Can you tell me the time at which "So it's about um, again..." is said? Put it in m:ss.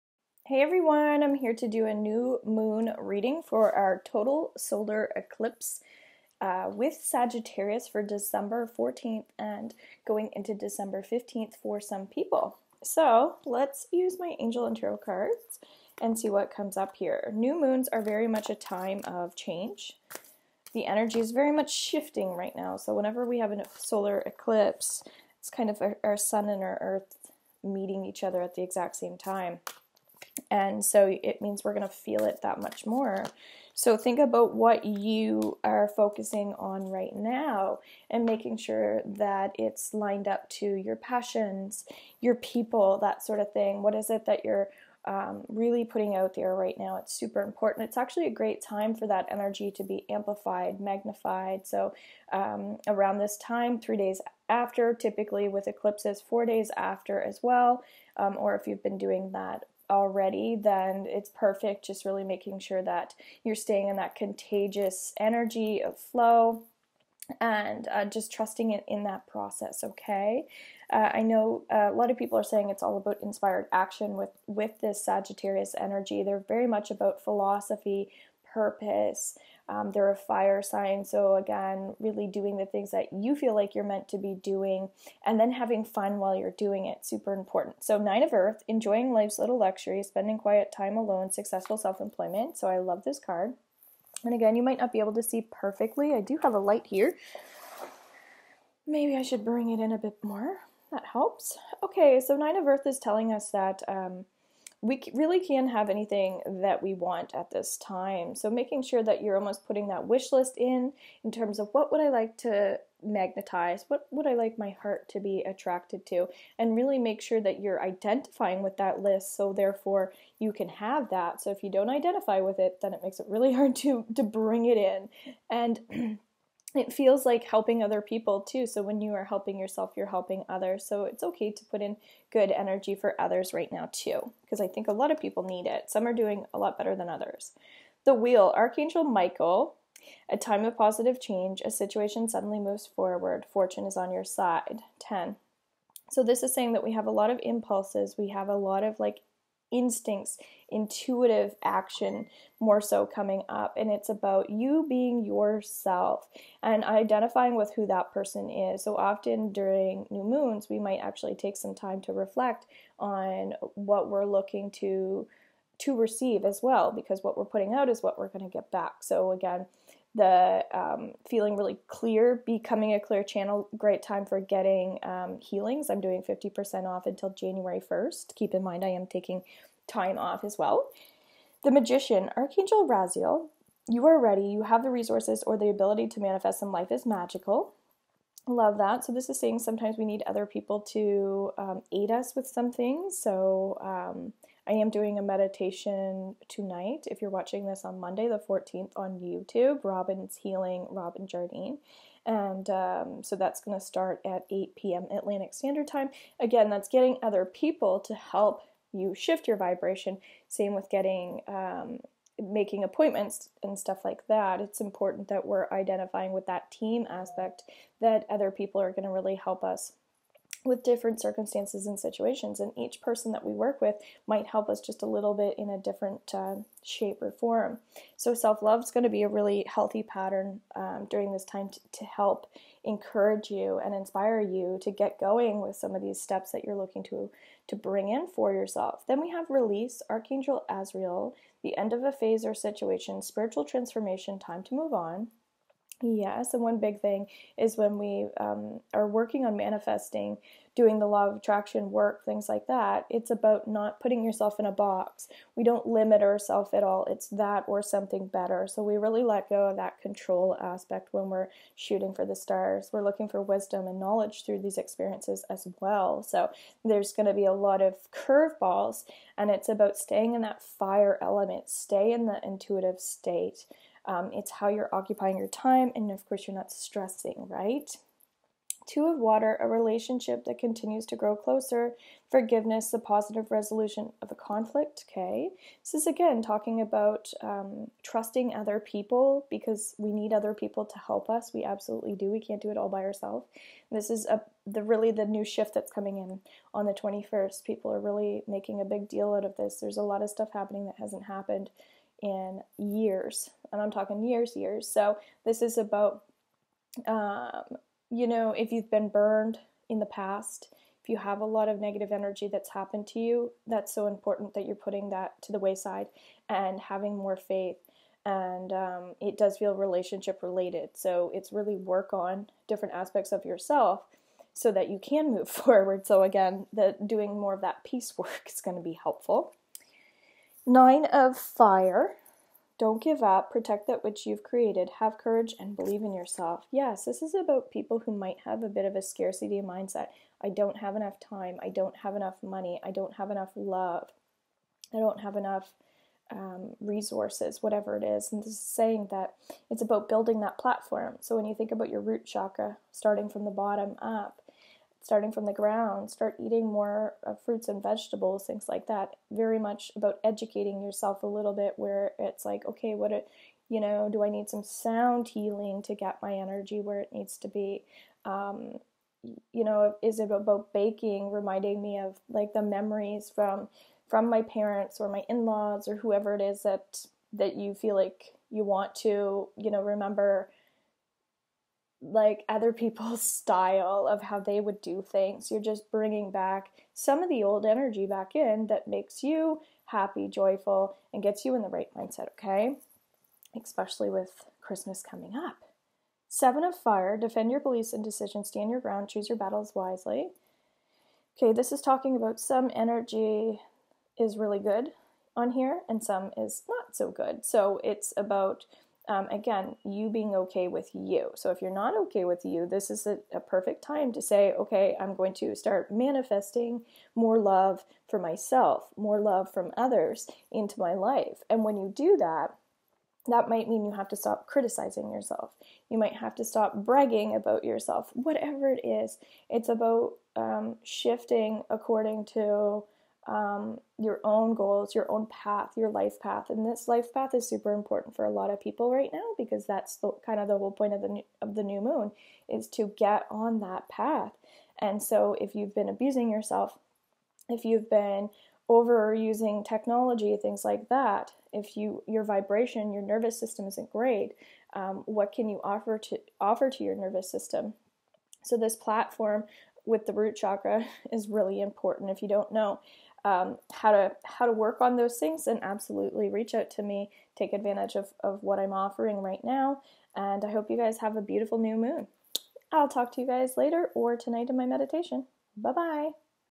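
6:47.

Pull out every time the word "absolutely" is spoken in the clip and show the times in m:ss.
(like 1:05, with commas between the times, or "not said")
4:51, 7:45.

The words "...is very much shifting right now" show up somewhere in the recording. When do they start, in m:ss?
0:21.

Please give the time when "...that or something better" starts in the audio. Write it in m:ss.
4:17.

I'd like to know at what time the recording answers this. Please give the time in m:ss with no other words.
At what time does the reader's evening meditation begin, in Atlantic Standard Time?
3:24.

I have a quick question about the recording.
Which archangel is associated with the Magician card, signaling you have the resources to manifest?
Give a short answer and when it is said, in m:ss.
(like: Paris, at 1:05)
Archangel Raziel, at 3:02.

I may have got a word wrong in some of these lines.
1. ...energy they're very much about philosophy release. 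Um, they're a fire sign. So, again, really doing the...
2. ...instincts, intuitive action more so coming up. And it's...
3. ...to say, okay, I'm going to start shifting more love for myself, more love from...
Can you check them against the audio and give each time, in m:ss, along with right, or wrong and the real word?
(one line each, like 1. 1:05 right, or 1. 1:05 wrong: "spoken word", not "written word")
1. 1:15 wrong: "purpose", not "release"
2. 2:29 right
3. 6:54 wrong: "manifesting", not "shifting".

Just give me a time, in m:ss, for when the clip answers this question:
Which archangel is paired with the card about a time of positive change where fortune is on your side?
2:18.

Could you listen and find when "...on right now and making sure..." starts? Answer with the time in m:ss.
0:36.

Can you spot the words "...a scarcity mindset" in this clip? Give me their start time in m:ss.
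5:38.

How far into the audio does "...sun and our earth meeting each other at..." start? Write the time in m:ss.
0:26.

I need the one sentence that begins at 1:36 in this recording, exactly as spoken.
I do have a light here.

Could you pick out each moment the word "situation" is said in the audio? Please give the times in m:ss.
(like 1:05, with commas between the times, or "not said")
2:21, 3:41, 4:02.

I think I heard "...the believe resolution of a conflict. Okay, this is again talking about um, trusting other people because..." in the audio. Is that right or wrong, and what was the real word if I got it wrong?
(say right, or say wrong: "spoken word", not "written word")
wrong: "positive", not "believe".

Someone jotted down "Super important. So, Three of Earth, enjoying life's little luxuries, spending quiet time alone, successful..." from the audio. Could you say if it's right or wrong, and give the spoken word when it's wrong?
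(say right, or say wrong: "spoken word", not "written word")
wrong: "Nine", not "Three".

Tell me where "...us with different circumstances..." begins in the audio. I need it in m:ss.
3:39.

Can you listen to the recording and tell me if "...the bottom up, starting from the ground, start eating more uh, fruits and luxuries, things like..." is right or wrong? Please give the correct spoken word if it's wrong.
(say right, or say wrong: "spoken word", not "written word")
wrong: "vegetables", not "luxuries".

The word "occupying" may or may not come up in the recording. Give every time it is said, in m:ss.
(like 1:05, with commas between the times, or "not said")
4:34.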